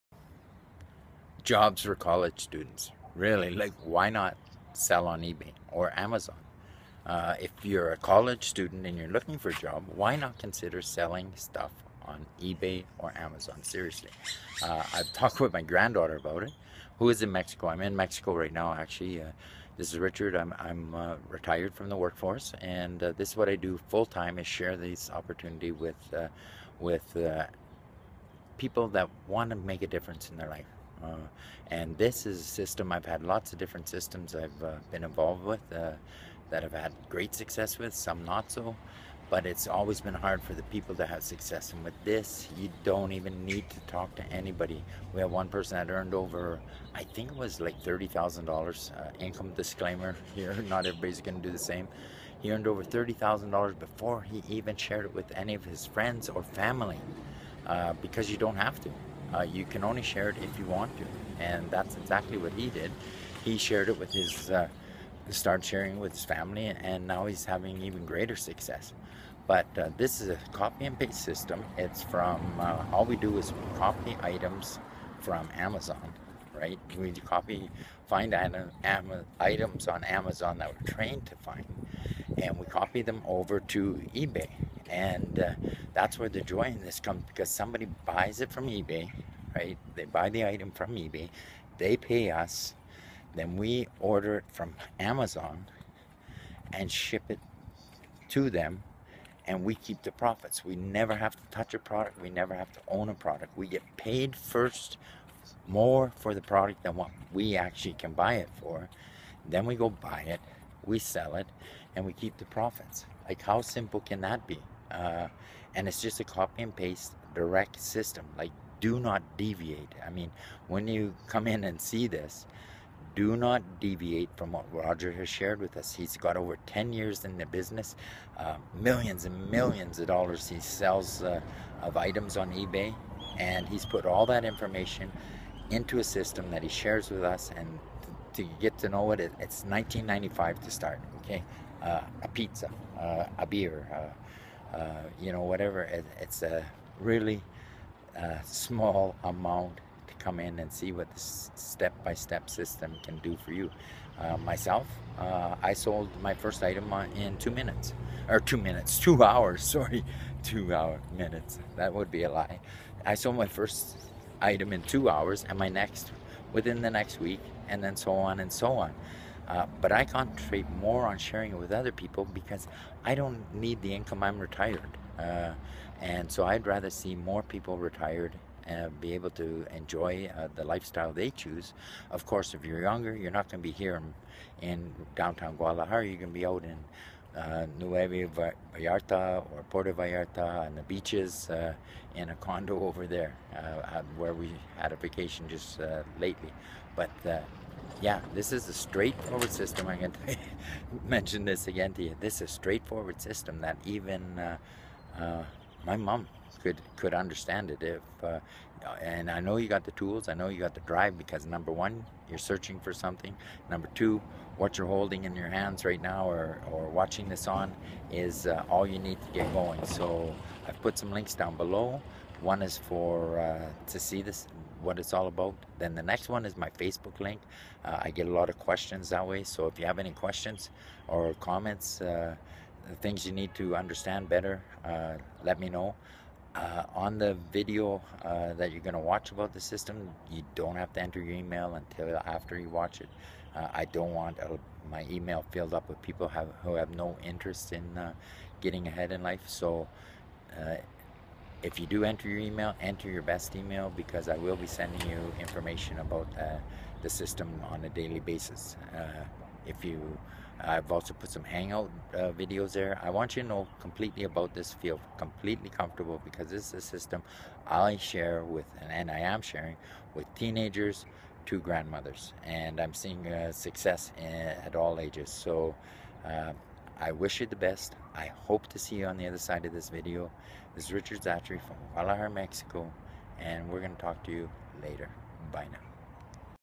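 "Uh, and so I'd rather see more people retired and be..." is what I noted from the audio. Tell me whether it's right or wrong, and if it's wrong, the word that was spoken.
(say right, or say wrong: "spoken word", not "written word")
right.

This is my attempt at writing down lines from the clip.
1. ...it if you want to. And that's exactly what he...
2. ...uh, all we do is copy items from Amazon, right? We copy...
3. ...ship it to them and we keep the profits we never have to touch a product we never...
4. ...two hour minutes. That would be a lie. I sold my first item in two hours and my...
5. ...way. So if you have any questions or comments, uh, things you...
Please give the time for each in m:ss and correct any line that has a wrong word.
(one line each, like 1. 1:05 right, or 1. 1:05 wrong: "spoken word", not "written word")
1. 1:00 right
2. 1:12 right
3. 1:36 right
4. 2:40 right
5. 3:49 right.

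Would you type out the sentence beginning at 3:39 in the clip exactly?
So I've put some links down below.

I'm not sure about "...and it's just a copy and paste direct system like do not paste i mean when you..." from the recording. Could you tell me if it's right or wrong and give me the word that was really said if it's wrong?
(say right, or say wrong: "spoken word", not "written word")
wrong: "deviate", not "paste".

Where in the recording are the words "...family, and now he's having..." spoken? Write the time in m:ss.
1:06.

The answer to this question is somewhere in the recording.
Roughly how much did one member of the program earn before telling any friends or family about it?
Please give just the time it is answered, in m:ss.
0:52.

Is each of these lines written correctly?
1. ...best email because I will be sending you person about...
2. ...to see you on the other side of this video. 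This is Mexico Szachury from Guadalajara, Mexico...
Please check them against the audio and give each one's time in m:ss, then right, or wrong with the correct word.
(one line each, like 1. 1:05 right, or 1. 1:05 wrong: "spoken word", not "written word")
1. 4:13 wrong: "information", not "person"
2. 4:38 wrong: "Richard", not "Mexico".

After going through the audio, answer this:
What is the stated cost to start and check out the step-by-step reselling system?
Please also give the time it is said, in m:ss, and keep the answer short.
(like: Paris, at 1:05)
$19.95, at 2:19.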